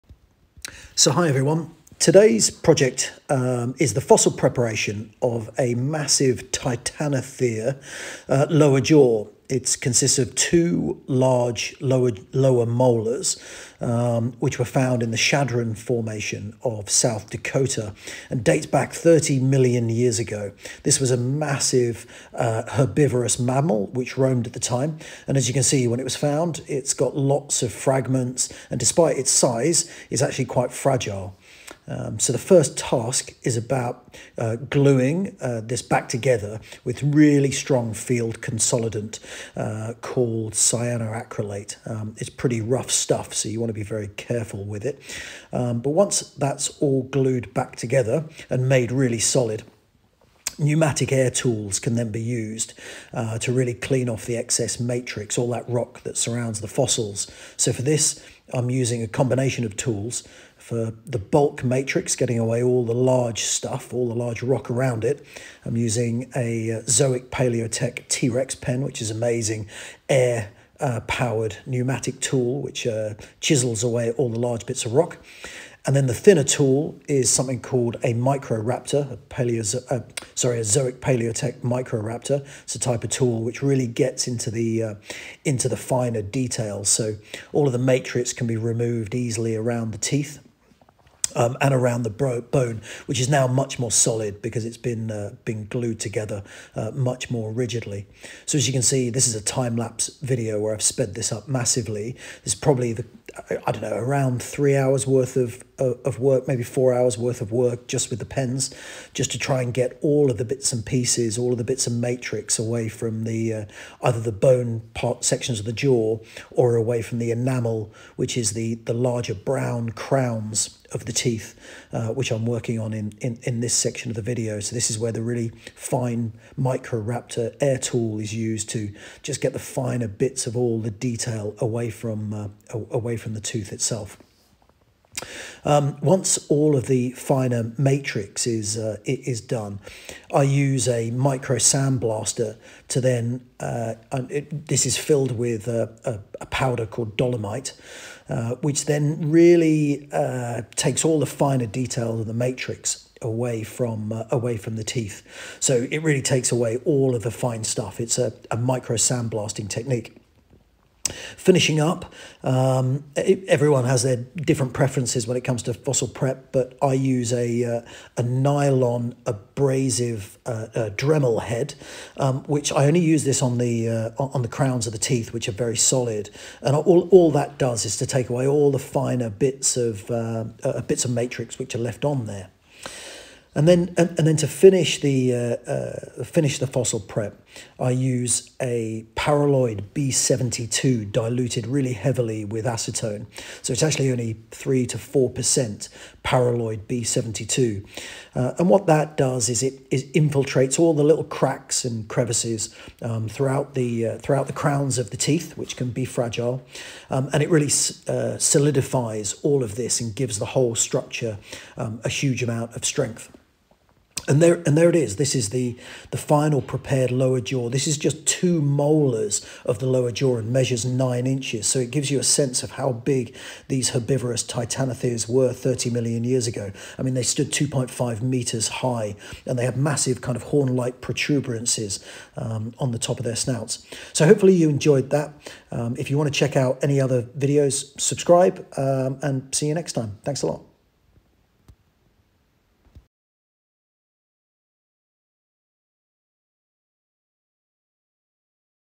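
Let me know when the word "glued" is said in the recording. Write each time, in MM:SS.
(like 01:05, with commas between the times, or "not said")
00:47, 01:35.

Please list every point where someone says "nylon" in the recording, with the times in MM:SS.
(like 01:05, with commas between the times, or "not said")
02:48.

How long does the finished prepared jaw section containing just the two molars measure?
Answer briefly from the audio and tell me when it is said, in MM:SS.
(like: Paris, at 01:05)
9 inches, at 03:40.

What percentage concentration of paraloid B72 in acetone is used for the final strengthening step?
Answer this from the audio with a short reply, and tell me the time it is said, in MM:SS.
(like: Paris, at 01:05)
3 to 4%, at 03:14.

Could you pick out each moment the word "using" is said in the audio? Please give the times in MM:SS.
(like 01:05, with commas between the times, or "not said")
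00:58, 01:05.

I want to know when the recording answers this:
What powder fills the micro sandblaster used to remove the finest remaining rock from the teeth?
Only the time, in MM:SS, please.
02:27.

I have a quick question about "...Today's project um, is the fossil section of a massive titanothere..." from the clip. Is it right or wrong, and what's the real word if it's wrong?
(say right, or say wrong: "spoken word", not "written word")
wrong: "preparation", not "section".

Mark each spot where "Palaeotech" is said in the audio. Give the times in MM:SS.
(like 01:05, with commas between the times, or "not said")
01:07, 01:20.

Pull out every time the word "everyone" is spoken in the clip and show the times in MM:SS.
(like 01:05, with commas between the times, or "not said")
00:01, 02:43.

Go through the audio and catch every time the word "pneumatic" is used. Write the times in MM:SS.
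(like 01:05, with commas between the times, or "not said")
00:50, 01:11.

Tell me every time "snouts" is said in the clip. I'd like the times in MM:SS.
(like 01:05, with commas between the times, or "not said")
03:53.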